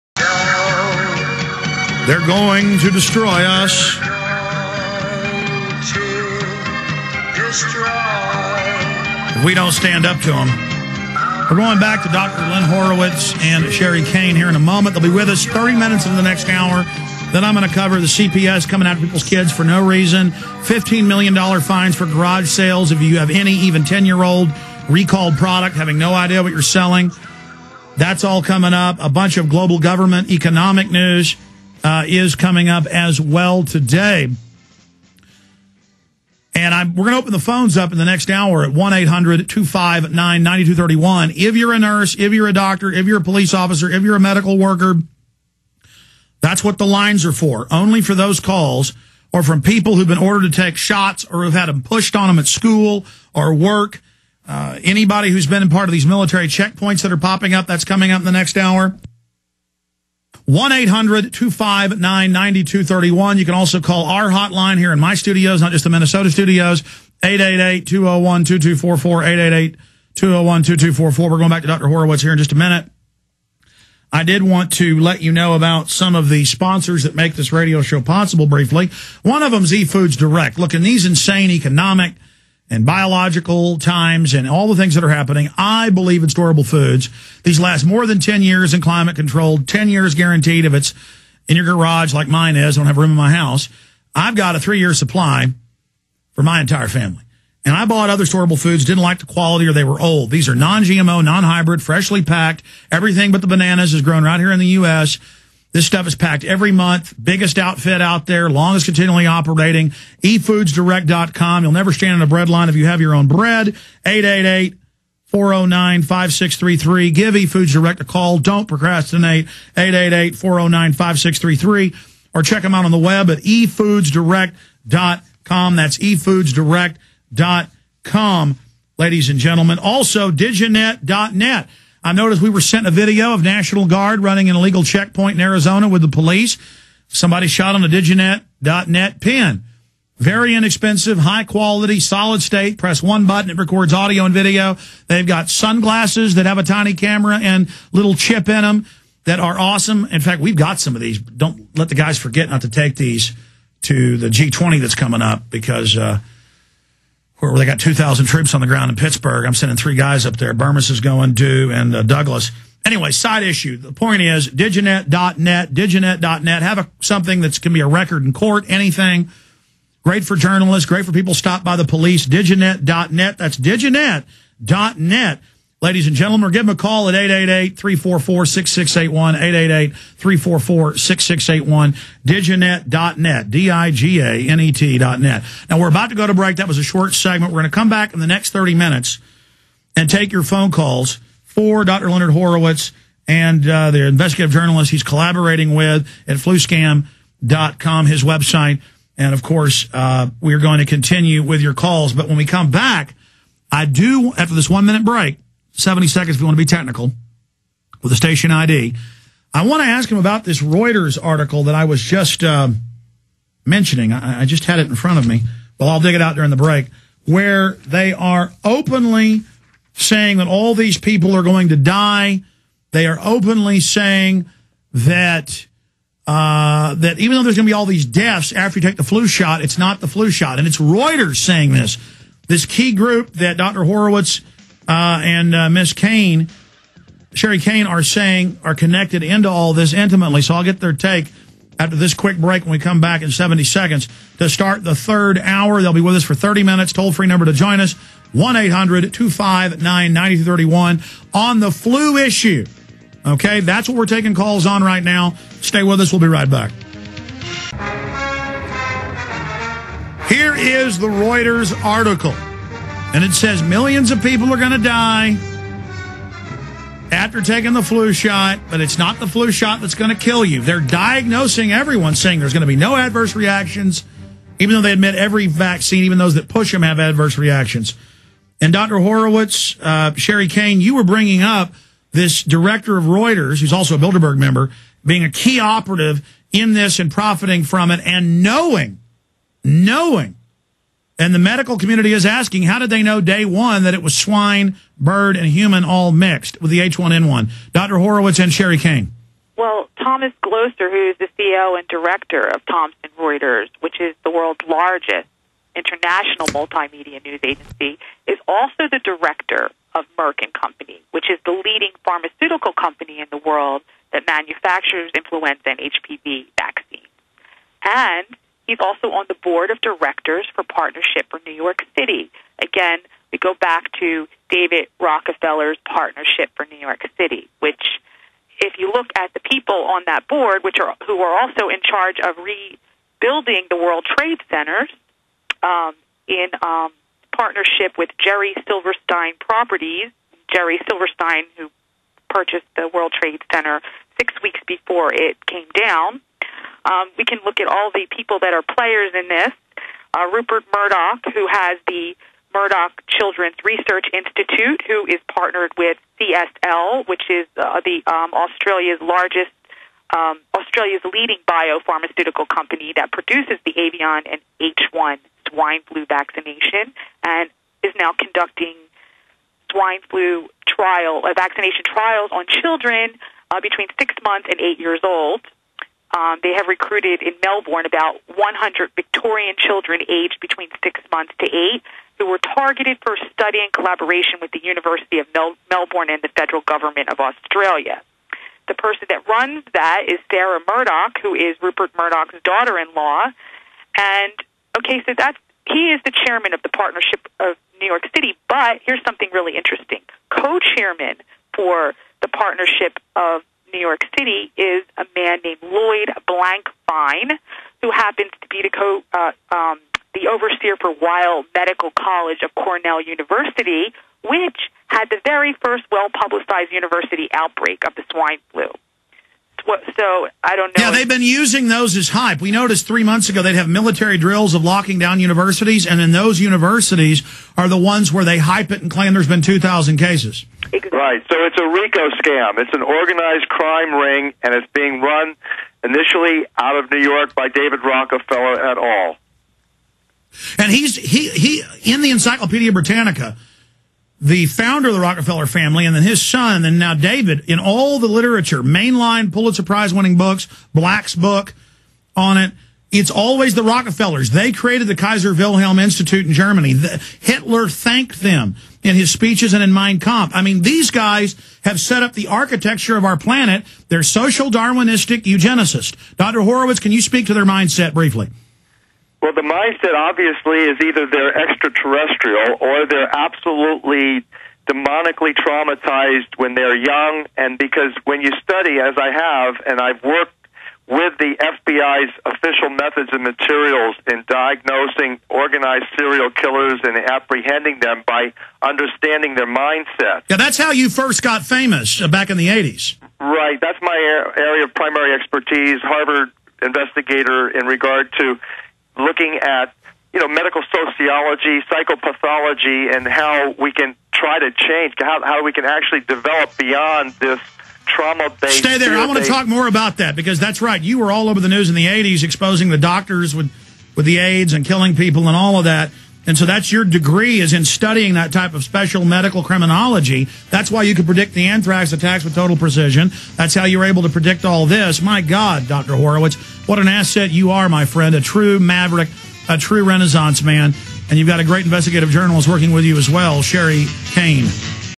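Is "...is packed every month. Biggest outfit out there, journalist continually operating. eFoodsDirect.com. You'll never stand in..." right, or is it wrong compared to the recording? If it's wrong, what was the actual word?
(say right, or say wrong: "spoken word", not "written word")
wrong: "longest", not "journalist".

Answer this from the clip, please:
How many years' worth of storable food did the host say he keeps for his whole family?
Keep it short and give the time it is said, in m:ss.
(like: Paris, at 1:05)
three-year, at 1:34.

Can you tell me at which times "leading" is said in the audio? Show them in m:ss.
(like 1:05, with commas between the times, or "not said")
5:11, 6:01.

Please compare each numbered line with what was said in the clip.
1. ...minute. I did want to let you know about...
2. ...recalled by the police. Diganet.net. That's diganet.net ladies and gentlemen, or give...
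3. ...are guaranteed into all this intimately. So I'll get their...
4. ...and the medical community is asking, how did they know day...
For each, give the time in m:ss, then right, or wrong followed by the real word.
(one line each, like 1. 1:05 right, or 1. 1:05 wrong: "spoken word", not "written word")
1. 1:12 right
2. 2:51 wrong: "stopped", not "recalled"
3. 3:58 wrong: "connected", not "guaranteed"
4. 4:51 right.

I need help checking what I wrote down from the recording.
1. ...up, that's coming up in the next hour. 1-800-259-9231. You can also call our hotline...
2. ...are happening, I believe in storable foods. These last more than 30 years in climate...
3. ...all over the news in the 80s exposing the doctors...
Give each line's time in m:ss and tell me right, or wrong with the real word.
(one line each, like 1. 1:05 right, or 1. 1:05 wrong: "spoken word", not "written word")
1. 0:57 right
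2. 1:25 wrong: "10", not "30"
3. 8:31 right.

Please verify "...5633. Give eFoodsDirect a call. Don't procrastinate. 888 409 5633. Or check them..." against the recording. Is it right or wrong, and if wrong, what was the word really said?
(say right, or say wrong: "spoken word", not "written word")
right.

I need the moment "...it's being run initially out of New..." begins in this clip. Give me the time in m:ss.
7:14.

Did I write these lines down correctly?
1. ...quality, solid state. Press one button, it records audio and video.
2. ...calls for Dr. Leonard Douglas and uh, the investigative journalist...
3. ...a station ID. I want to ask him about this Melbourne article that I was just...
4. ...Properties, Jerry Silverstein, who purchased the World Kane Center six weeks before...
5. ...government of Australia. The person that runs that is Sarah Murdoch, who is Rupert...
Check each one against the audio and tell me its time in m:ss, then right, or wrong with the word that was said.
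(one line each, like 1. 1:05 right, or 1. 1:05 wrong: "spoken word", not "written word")
1. 2:21 right
2. 3:10 wrong: "Horowitz", not "Douglas"
3. 3:28 wrong: "Reuters", not "Melbourne"
4. 5:39 wrong: "Trade", not "Kane"
5. 6:26 right.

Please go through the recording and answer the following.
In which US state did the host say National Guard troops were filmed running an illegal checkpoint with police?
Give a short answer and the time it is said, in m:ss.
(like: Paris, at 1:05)
Arizona, at 2:15.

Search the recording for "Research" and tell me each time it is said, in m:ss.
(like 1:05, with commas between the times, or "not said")
5:53.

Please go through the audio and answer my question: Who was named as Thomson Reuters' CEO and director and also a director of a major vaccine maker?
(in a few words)
Thomas Glocer.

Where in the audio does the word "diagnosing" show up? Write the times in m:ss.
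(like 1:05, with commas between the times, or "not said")
4:30, 8:04.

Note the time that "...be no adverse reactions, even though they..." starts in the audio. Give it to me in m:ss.
4:32.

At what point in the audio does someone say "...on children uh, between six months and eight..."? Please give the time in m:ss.
6:12.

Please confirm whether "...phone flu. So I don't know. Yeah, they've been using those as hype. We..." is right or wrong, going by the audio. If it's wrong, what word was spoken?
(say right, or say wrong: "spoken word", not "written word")
wrong: "swine", not "phone".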